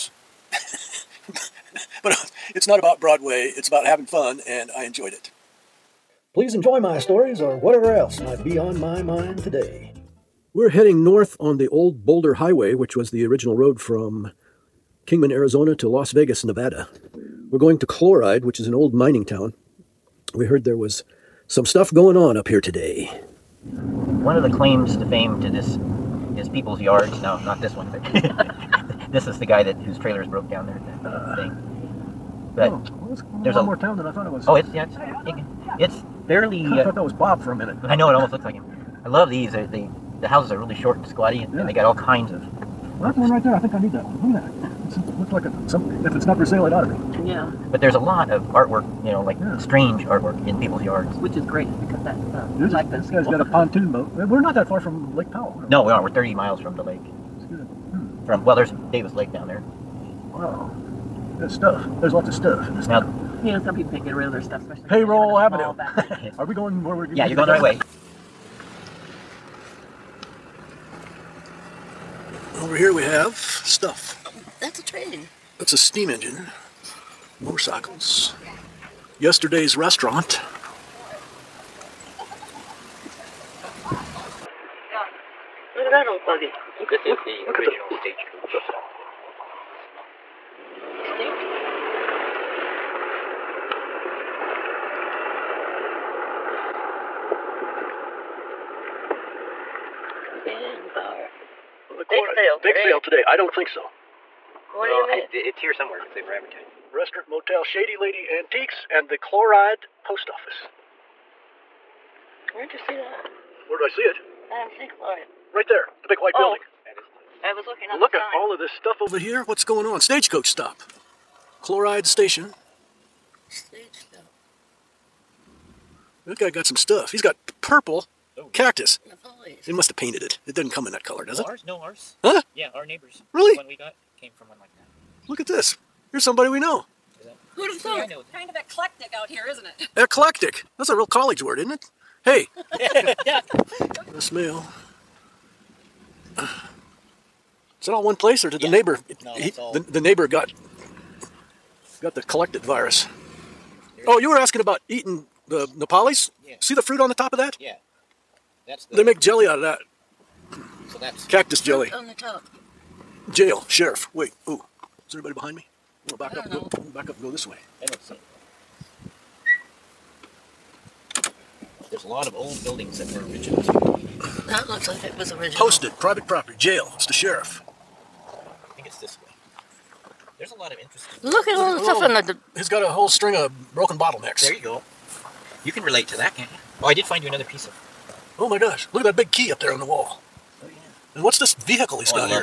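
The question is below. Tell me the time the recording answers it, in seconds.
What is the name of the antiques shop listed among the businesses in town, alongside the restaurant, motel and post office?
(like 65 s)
107 s.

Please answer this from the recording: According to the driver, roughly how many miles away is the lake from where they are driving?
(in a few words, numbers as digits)
30.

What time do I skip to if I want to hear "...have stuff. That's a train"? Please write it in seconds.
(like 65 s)
73 s.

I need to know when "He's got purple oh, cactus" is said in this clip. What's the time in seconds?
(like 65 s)
127 s.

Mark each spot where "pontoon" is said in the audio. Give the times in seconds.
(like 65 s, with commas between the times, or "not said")
53 s.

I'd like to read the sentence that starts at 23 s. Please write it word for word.
One of the claims to fame to this is people's yards.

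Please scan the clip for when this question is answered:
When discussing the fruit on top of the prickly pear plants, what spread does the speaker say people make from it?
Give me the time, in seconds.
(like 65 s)
161 s.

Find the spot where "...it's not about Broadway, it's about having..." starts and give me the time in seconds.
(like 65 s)
2 s.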